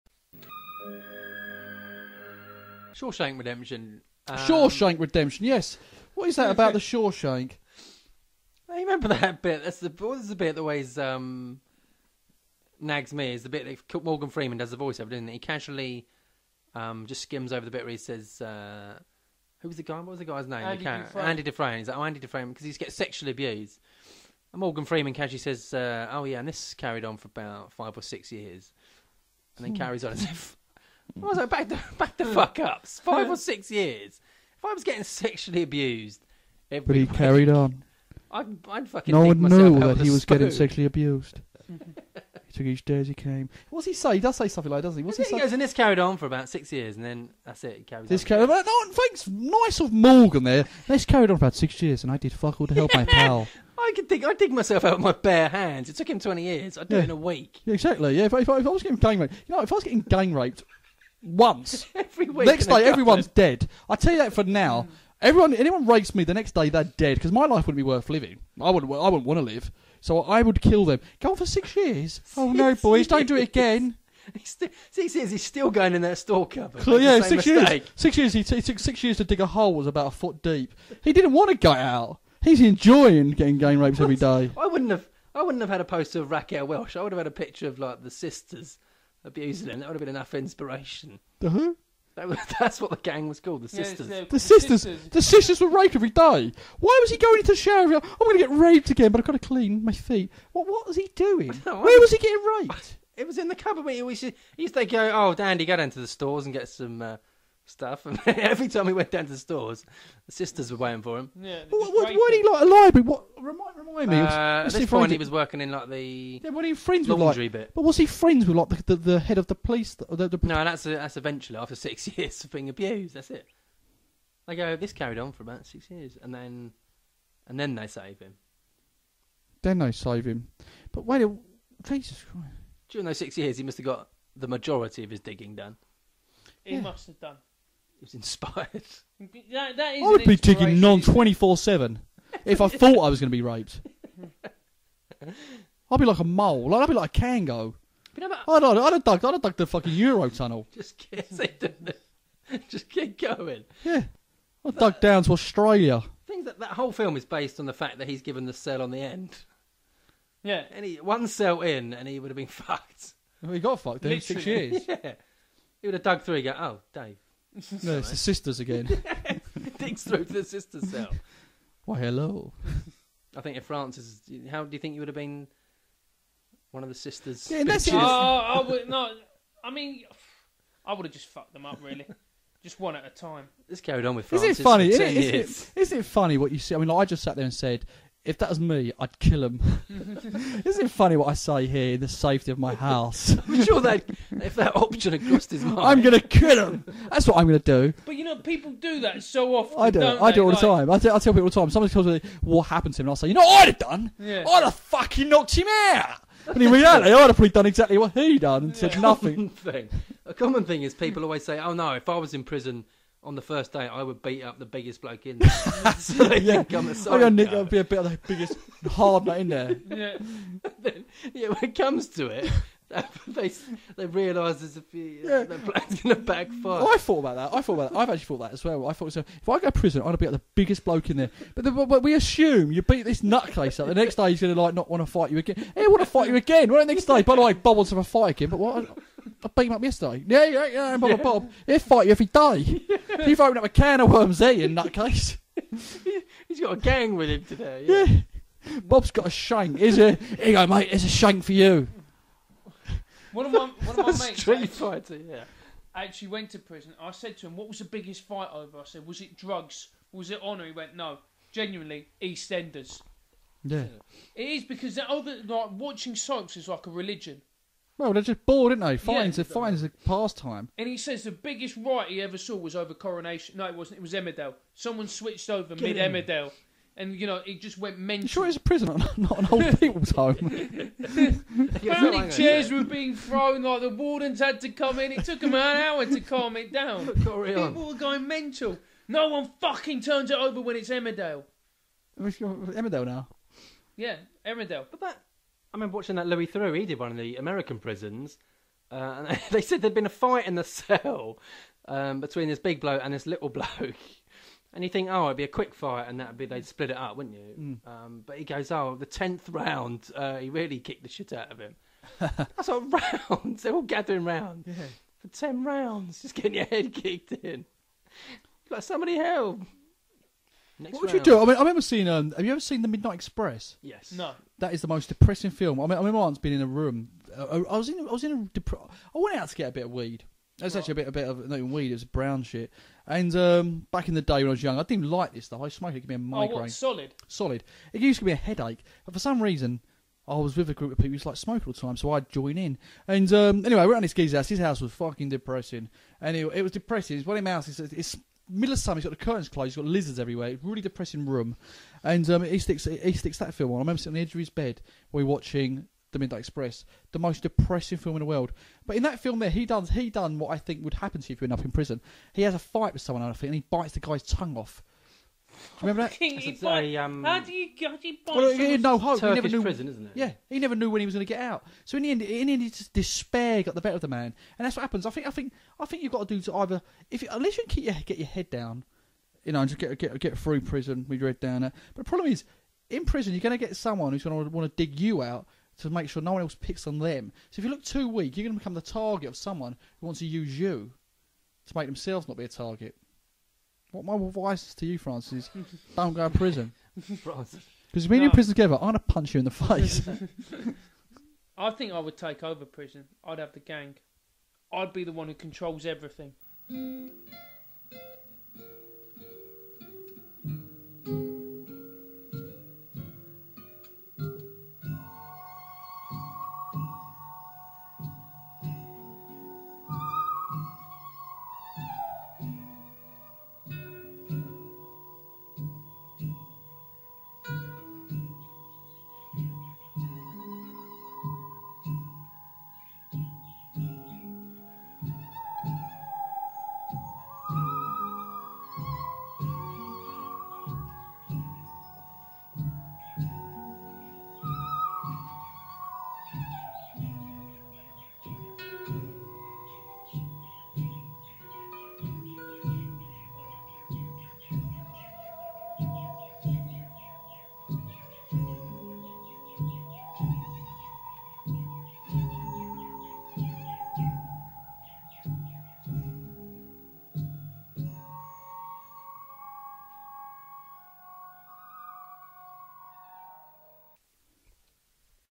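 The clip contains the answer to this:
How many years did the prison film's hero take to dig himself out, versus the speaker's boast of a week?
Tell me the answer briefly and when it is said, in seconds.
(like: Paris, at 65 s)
20, at 56 s.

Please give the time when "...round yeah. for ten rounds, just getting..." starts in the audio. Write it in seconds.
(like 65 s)
314 s.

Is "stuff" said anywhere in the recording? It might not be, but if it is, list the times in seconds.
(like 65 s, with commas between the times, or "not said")
107 s, 335 s.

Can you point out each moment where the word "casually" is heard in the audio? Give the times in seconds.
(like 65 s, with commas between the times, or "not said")
15 s, 25 s.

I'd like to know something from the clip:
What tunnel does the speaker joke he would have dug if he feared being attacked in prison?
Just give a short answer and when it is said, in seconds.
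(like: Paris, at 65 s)
Euro tunnel, at 149 s.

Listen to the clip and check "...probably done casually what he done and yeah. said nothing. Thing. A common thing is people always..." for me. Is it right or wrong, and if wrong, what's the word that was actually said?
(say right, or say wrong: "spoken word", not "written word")
wrong: "exactly", not "casually".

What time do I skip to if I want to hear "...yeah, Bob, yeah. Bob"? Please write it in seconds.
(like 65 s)
240 s.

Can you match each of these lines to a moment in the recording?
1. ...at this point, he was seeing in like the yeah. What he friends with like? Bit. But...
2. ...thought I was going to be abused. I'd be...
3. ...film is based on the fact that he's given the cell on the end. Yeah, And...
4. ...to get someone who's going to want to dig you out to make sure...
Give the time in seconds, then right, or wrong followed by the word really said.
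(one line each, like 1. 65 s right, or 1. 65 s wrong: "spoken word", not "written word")
1. 114 s wrong: "working", not "seeing"
2. 142 s wrong: "raped", not "abused"
3. 156 s right
4. 383 s right.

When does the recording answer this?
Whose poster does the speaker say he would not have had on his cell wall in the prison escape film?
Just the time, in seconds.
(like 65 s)
86 s.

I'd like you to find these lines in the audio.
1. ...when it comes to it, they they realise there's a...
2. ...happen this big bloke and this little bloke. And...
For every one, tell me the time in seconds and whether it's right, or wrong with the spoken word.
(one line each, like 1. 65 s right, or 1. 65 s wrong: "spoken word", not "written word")
1. 221 s right
2. 302 s wrong: "between", not "happen".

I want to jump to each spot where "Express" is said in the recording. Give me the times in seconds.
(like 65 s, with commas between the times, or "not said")
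323 s, 356 s.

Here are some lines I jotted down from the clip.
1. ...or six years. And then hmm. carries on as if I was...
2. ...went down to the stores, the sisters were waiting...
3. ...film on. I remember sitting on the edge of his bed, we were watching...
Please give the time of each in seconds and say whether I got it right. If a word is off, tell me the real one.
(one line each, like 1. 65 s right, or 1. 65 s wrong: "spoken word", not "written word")
1. 27 s right
2. 108 s right
3. 353 s right.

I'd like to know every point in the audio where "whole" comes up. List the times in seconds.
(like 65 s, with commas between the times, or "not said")
156 s.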